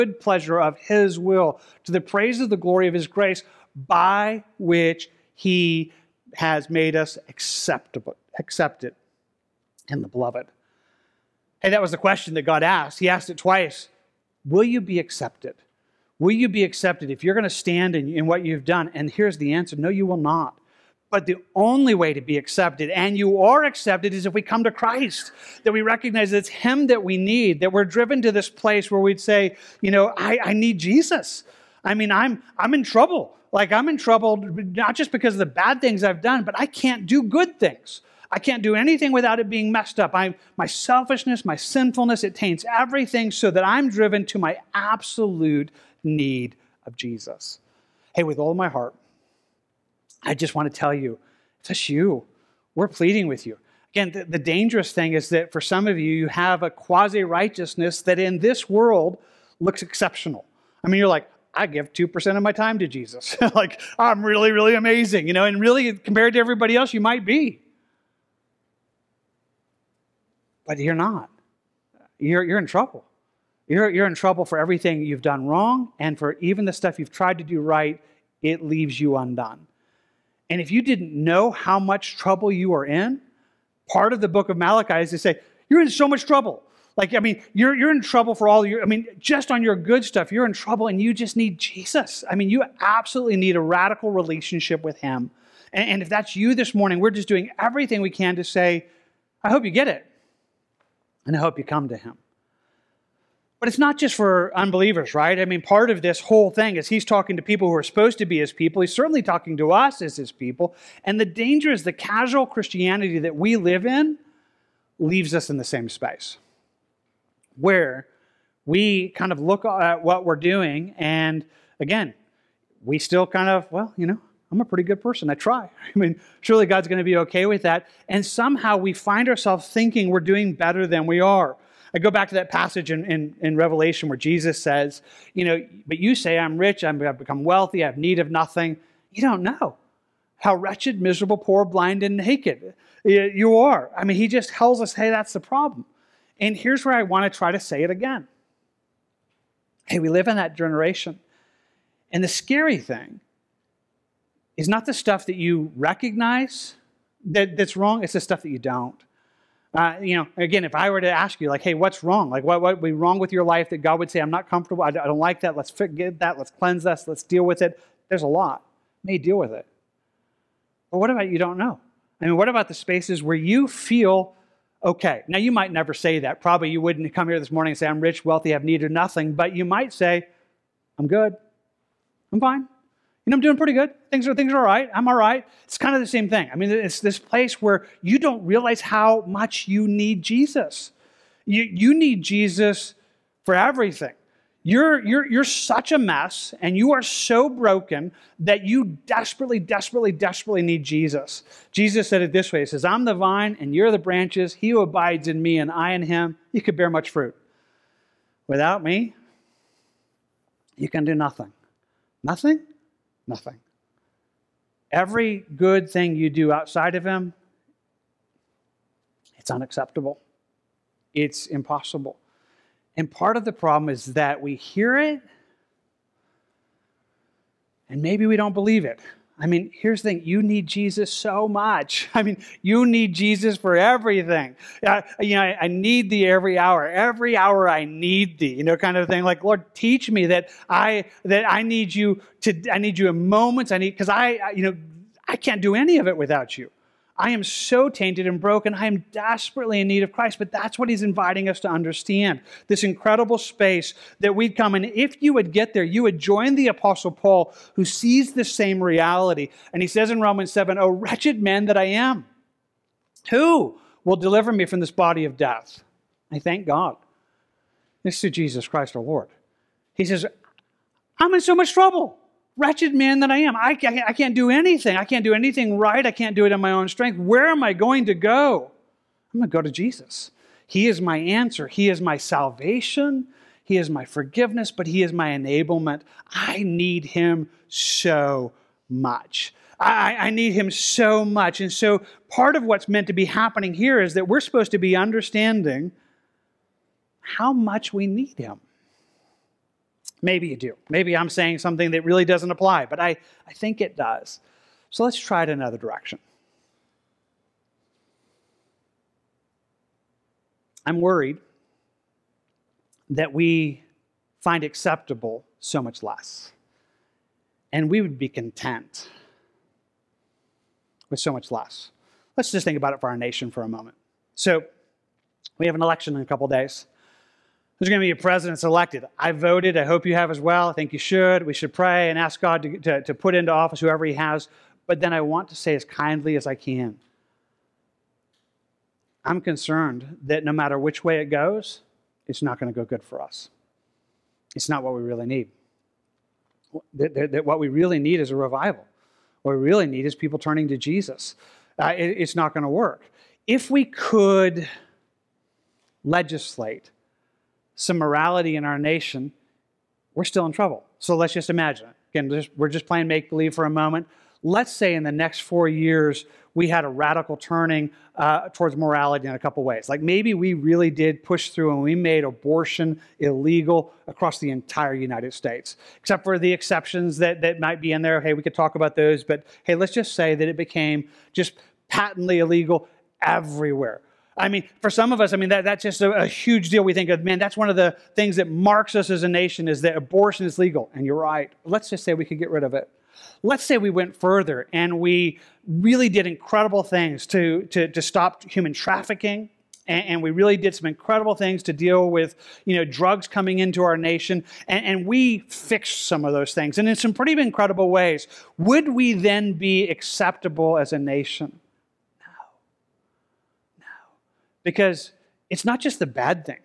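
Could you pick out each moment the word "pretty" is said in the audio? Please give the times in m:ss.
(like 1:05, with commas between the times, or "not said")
2:04, 3:03, 6:47.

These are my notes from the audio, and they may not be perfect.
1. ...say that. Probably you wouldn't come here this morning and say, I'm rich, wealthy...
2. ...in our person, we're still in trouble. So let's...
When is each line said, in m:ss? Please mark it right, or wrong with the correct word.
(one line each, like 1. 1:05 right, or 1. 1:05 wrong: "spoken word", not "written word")
1. 2:55 right
2. 5:58 wrong: "nation", not "person".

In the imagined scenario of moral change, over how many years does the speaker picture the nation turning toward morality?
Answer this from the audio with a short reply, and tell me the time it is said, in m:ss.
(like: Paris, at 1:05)
4 years, at 6:05.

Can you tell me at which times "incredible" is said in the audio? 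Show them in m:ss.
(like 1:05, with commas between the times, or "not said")
4:12, 6:36, 6:40, 6:47.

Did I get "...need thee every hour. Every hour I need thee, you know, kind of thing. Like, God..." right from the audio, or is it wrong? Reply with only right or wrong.
wrong.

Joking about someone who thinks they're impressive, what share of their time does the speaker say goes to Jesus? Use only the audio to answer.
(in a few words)
2%.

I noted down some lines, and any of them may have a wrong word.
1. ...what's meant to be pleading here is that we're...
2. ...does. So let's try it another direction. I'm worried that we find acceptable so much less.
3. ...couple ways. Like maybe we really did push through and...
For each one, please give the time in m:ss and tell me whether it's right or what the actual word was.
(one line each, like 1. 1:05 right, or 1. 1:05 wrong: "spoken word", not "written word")
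1. 4:52 wrong: "happening", not "pleading"
2. 5:03 right
3. 6:09 right.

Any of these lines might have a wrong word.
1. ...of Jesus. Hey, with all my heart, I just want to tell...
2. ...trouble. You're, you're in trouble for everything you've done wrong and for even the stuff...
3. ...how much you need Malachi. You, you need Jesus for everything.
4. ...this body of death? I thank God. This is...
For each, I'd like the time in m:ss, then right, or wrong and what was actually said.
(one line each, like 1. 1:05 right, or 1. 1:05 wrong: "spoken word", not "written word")
1. 0:46 right
2. 1:12 right
3. 3:08 wrong: "Jesus", not "Malachi"
4. 4:24 right.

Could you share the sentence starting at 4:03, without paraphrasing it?
I need because I, I you know I can't do any of it without you.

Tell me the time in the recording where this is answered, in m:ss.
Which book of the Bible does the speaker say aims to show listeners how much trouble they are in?
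1:24.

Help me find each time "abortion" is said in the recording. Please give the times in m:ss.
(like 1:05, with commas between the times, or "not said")
6:12, 6:29.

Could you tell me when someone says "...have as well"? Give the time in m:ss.
5:30.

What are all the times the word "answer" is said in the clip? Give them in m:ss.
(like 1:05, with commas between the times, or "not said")
0:19, 4:41.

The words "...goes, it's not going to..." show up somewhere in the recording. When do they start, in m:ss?
5:41.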